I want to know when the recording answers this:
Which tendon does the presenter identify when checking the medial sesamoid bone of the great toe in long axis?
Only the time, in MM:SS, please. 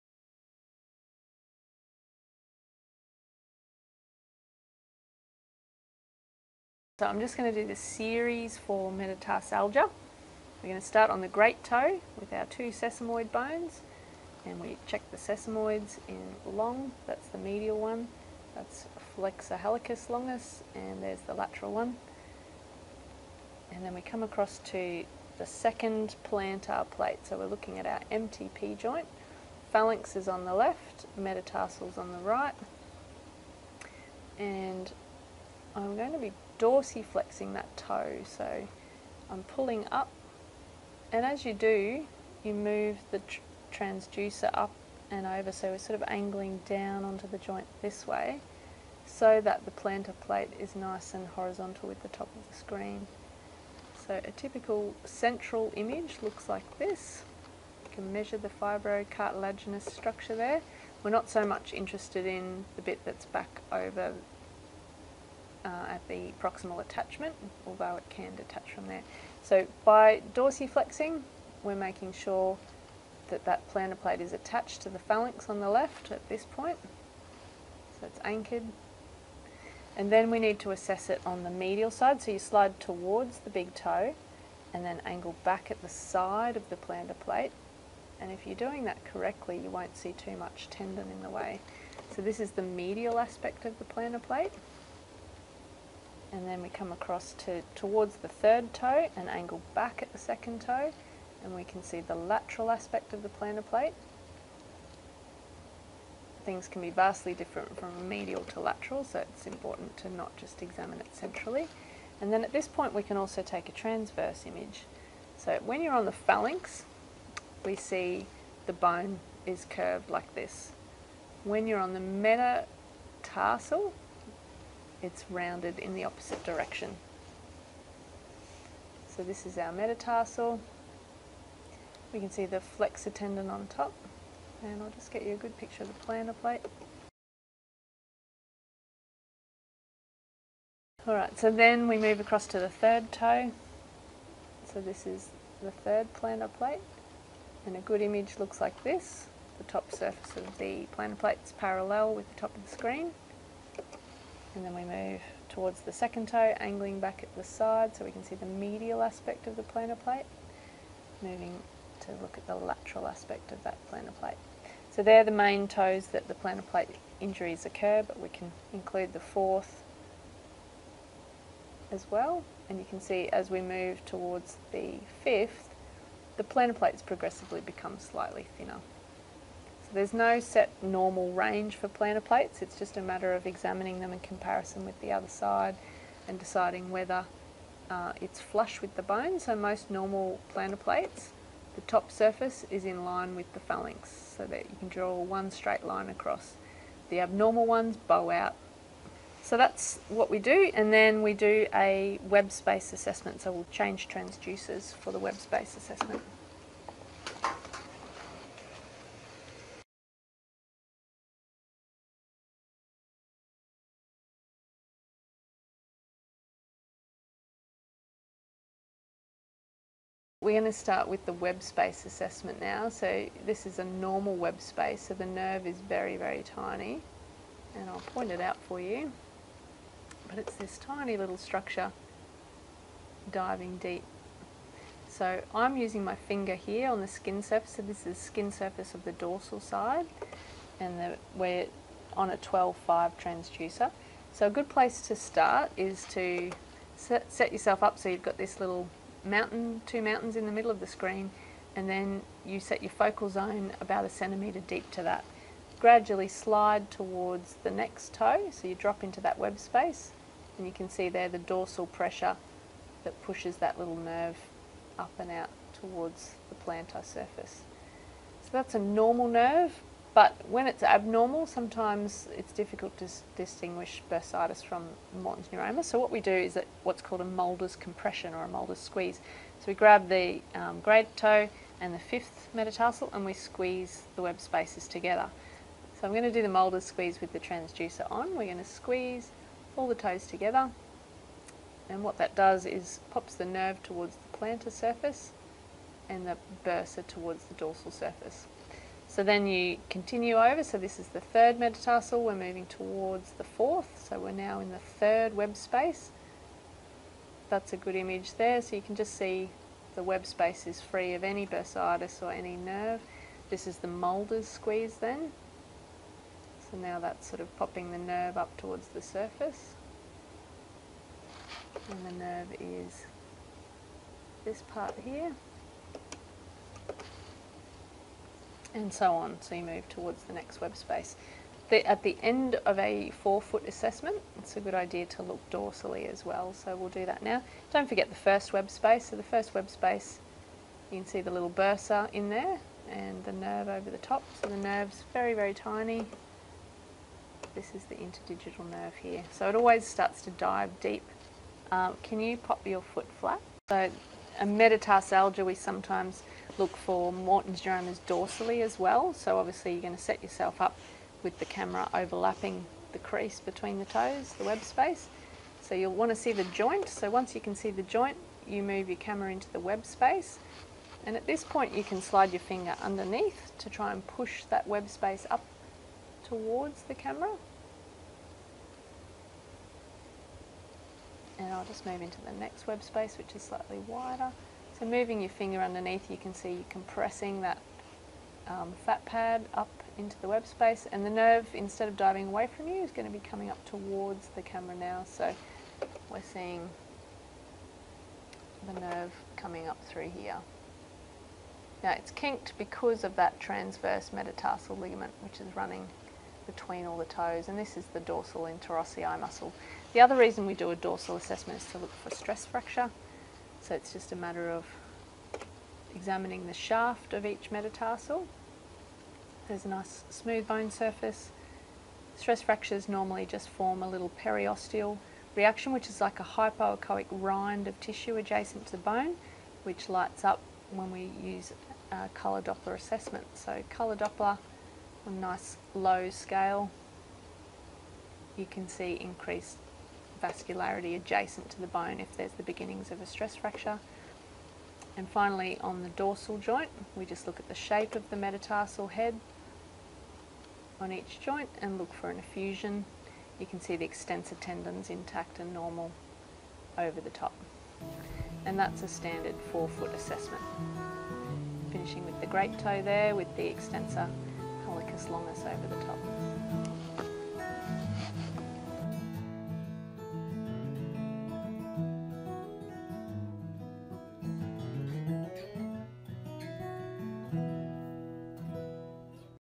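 00:19.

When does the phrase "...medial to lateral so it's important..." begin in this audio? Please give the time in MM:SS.
01:48.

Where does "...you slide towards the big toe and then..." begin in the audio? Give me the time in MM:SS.
01:22.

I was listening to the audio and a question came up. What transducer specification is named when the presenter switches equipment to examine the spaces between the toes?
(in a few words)
12-5.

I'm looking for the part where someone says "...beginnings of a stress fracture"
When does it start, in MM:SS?
07:22.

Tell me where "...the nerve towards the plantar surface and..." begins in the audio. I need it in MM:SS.
04:53.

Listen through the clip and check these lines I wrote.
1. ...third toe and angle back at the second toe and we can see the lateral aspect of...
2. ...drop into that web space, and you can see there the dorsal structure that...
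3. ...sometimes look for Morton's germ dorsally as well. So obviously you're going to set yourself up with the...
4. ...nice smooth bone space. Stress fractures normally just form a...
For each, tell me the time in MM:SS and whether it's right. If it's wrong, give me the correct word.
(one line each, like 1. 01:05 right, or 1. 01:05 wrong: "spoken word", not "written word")
1. 01:38 right
2. 04:18 wrong: "pressure", not "structure"
3. 05:55 right
4. 06:59 wrong: "surface", not "space".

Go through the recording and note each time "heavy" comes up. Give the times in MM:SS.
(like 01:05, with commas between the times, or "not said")
not said.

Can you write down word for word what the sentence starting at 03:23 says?
So we'll change transducers for the web space assessment.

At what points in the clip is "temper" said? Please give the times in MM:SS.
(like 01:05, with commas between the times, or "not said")
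not said.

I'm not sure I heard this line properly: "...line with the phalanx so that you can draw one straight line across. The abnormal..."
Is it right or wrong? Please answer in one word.
right.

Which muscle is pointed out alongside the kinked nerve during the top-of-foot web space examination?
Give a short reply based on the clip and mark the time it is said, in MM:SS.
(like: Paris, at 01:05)
dorsal interossei, at 06:47.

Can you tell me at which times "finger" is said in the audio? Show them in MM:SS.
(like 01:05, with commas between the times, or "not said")
03:56, 06:12, 06:25.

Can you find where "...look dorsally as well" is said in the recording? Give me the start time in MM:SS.
05:35.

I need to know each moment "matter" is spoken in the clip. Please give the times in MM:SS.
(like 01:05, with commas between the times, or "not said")
03:03, 06:54.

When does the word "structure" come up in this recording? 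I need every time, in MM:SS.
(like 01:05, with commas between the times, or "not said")
00:59, 03:51.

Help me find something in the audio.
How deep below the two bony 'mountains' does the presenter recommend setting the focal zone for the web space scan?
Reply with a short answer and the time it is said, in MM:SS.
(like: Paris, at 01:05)
about a centimetre, at 04:13.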